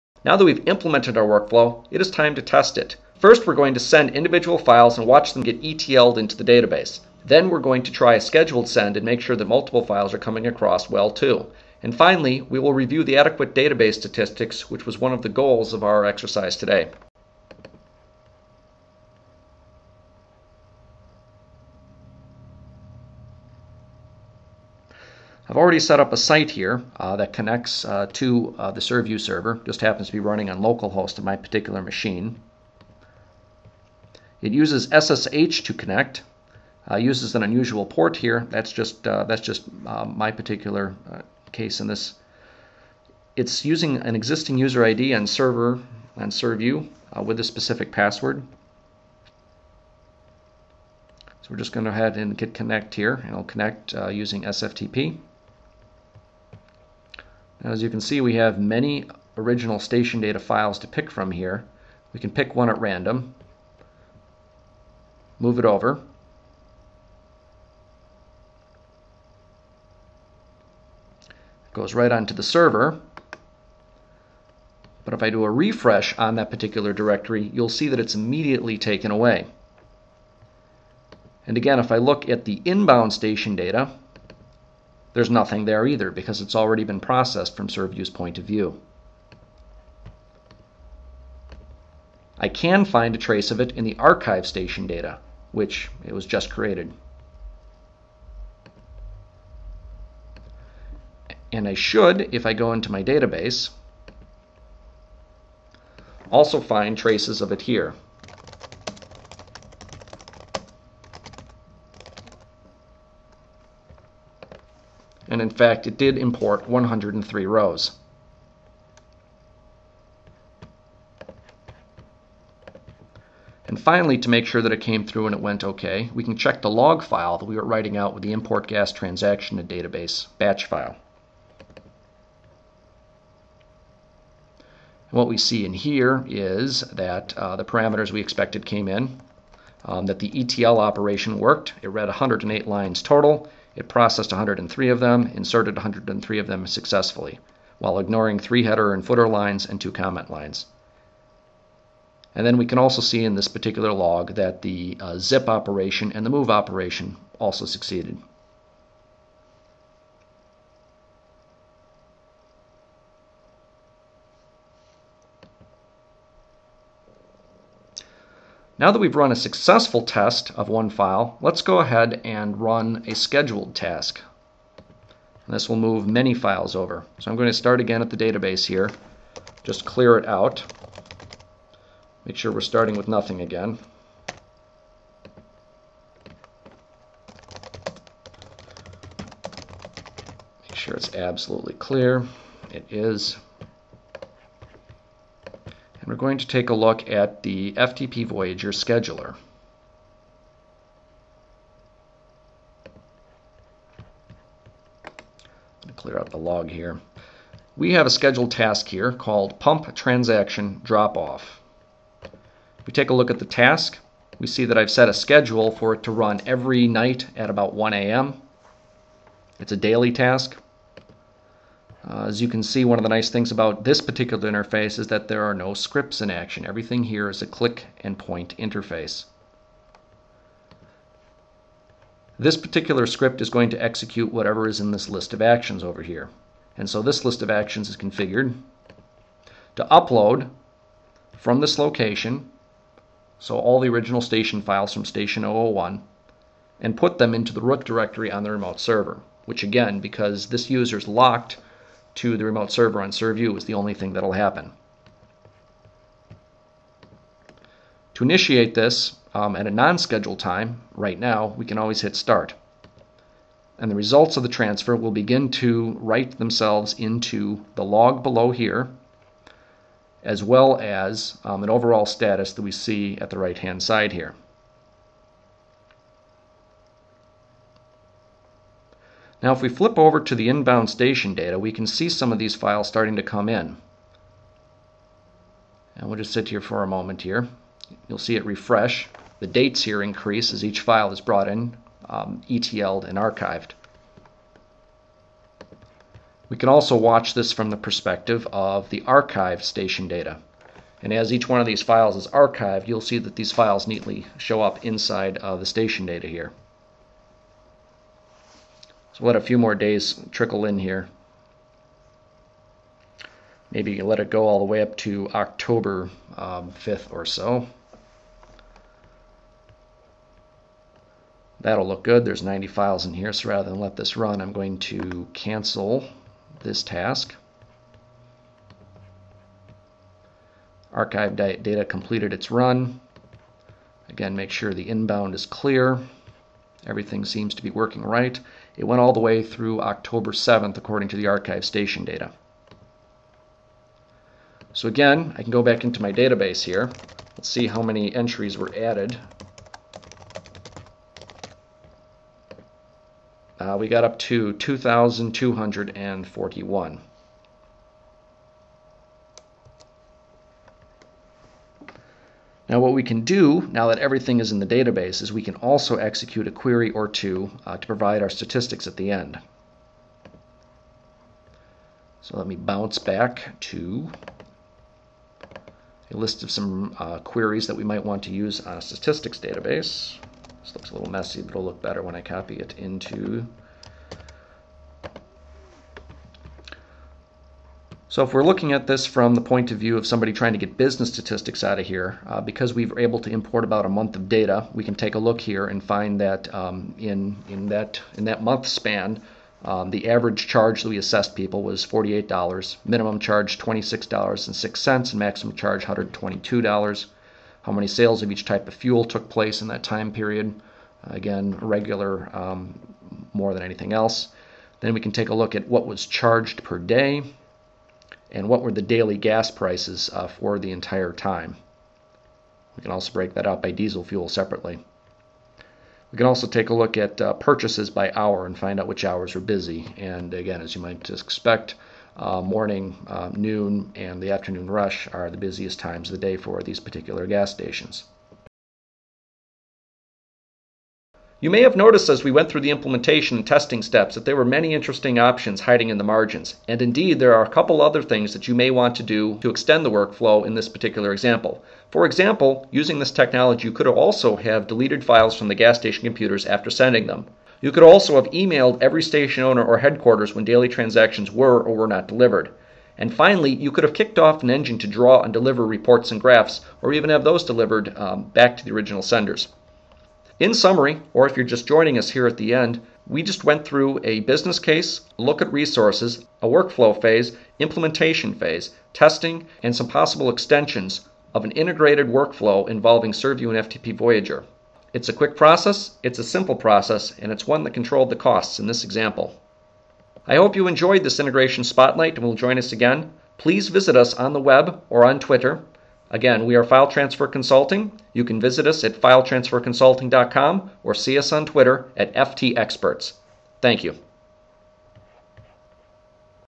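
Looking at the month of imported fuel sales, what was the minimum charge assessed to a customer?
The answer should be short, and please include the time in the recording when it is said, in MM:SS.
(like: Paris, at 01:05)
$26.06, at 06:43.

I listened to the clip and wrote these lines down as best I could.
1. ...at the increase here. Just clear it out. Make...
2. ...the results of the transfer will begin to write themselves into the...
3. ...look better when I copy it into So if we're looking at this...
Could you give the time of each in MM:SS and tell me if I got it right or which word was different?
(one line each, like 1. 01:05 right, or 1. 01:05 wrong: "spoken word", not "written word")
1. 02:58 wrong: "database", not "increase"
2. 04:23 right
3. 06:21 right.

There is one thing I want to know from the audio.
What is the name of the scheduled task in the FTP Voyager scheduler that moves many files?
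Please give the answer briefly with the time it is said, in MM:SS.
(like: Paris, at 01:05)
Pump Transaction Drop Off, at 03:29.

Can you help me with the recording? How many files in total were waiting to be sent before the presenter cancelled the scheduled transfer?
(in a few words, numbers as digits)
90.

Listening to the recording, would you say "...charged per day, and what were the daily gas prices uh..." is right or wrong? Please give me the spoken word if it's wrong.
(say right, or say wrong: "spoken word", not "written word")
right.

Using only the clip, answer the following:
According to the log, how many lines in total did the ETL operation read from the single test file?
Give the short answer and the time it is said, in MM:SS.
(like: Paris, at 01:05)
108, at 02:22.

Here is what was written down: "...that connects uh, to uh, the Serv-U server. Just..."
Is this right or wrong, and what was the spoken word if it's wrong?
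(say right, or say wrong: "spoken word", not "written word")
right.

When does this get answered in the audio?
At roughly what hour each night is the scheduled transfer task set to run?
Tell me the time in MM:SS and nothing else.
03:37.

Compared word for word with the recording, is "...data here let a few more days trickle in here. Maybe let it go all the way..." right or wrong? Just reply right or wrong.
right.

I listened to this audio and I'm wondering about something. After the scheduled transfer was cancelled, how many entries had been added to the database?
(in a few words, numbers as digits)
2,241.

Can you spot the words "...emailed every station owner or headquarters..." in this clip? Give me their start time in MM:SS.
07:38.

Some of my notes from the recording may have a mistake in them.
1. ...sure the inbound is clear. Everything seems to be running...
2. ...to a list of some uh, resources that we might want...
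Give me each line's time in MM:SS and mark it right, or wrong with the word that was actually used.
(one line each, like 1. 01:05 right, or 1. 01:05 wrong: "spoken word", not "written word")
1. 05:34 wrong: "working", not "running"
2. 06:13 wrong: "queries", not "resources".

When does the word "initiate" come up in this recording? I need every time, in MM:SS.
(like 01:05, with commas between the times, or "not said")
04:18.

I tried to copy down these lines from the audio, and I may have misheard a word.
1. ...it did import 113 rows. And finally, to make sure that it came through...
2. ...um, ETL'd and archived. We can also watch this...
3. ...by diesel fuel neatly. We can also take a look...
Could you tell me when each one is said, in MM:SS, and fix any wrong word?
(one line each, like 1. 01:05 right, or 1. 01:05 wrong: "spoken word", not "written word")
1. 01:55 wrong: "103", not "113"
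2. 04:52 right
3. 07:03 wrong: "separately", not "neatly".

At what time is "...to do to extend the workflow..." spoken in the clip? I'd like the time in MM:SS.
07:28.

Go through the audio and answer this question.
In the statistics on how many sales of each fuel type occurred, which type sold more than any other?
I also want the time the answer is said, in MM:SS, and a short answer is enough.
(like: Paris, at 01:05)
Regular, at 06:51.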